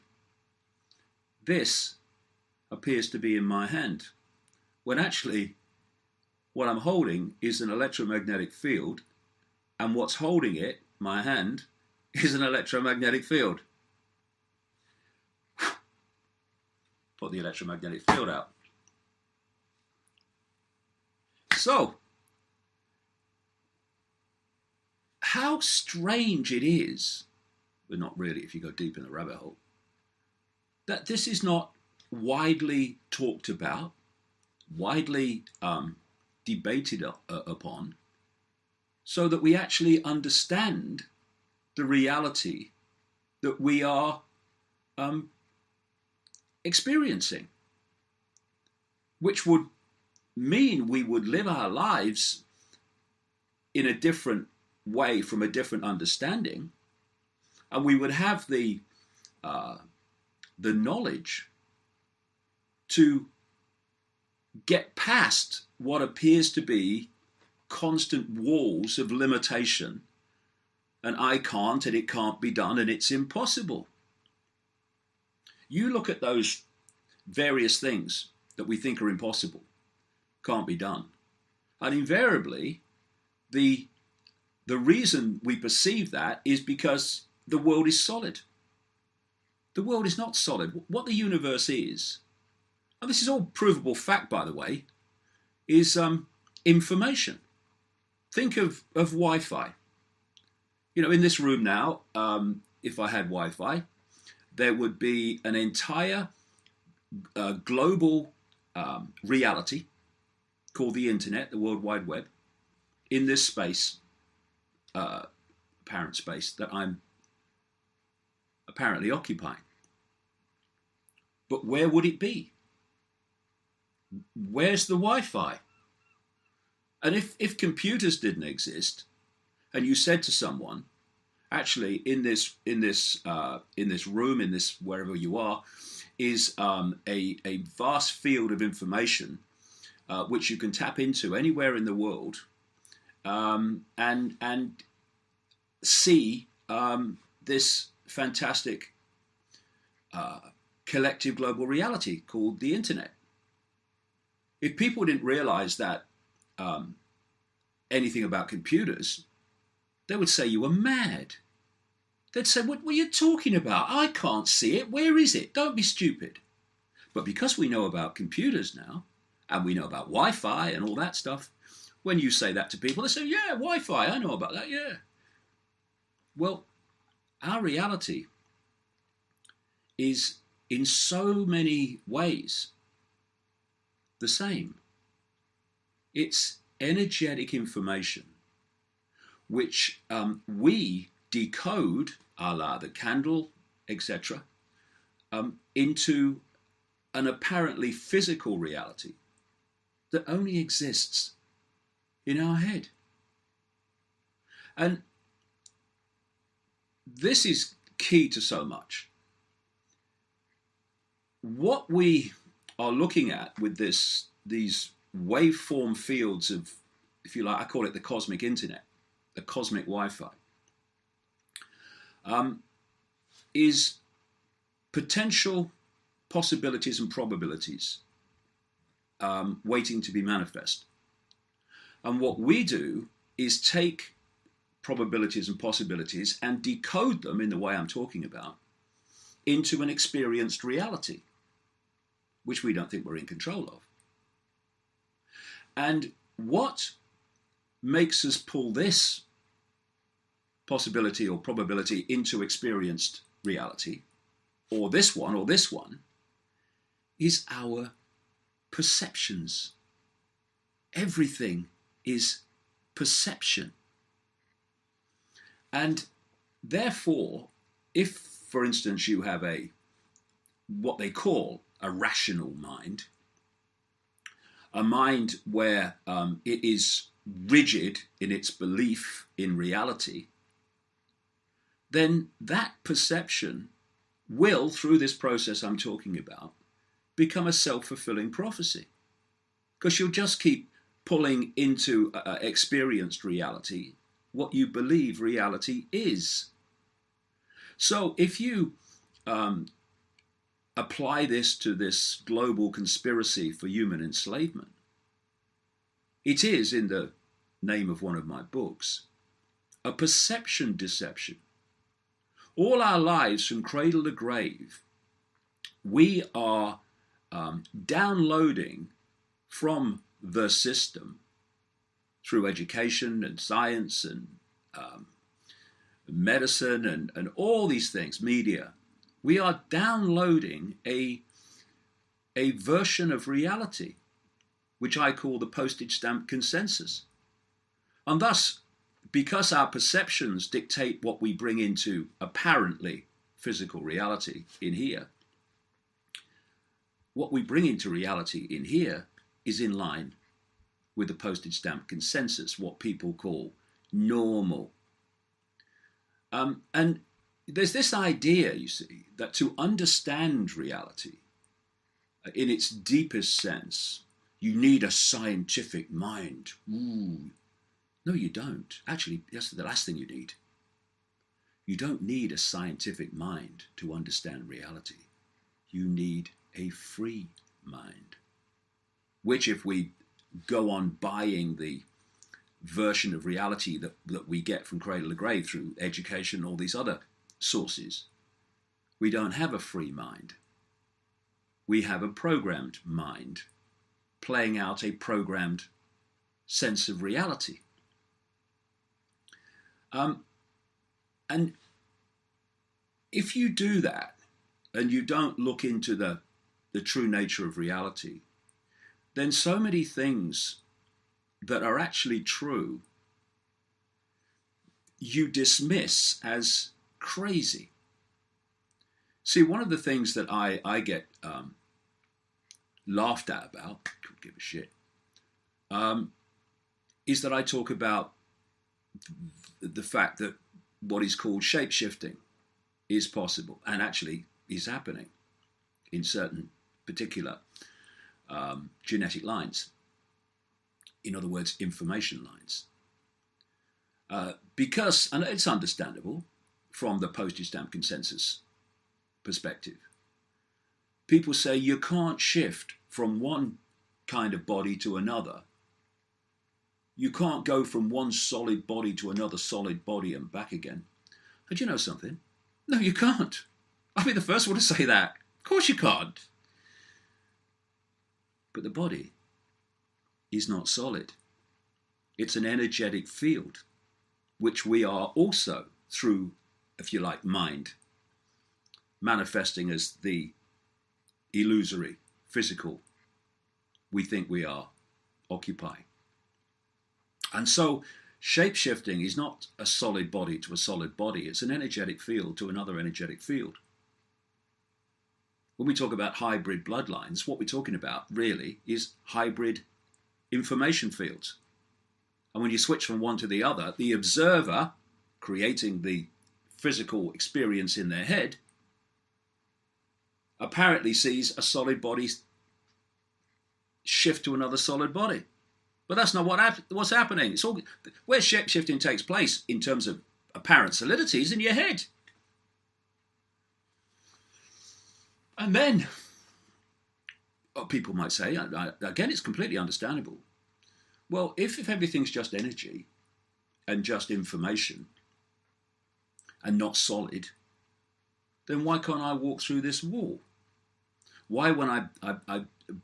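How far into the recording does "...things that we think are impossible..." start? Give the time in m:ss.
1:17.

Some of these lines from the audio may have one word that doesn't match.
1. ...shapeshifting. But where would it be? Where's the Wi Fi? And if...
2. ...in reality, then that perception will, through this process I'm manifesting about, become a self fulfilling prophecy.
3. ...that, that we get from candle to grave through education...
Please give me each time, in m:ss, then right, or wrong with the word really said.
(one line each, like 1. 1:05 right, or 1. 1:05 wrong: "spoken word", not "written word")
1. 1:59 wrong: "occupying", not "shapeshifting"
2. 4:39 wrong: "talking", not "manifesting"
3. 6:23 wrong: "cradle", not "candle".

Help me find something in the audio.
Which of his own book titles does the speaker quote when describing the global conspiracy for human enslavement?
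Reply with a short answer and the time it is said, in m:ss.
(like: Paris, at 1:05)
Perception Deception, at 5:09.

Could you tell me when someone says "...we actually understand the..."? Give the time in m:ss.
0:39.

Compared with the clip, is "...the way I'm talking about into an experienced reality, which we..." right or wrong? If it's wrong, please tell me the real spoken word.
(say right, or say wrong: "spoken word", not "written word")
right.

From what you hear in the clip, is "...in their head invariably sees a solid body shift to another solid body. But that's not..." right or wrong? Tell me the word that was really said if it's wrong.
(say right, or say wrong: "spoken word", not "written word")
wrong: "apparently", not "invariably".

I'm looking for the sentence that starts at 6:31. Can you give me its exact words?
We have a programmed mind playing out a programmed sense of reality.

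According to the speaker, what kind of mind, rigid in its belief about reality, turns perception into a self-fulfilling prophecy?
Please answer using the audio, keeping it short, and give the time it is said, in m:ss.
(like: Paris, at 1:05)
a rational mind, at 4:31.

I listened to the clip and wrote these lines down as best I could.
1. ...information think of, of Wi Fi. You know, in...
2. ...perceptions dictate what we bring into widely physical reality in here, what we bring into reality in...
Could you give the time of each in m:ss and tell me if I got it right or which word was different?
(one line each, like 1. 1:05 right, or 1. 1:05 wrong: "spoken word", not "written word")
1. 1:36 right
2. 5:39 wrong: "apparently", not "widely".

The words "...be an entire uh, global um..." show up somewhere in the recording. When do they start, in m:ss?
1:44.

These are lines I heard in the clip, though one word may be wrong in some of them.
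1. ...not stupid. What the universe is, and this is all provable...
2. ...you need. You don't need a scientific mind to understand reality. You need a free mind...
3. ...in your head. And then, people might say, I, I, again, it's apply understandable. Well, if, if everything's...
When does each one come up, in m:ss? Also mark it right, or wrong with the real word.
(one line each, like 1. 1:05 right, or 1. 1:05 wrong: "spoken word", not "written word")
1. 1:30 wrong: "solid", not "stupid"
2. 6:09 right
3. 8:41 wrong: "completely", not "apply".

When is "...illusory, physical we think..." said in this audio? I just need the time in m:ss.
8:01.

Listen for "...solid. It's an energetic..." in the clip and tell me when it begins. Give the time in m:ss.
7:50.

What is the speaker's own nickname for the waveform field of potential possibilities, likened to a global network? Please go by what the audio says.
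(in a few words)
the cosmic internet.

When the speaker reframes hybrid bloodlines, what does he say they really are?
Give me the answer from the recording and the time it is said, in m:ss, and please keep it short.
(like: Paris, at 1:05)
hybrid information fields, at 8:19.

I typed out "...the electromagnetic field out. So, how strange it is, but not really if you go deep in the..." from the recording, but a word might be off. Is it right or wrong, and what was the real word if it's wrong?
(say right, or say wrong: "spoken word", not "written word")
right.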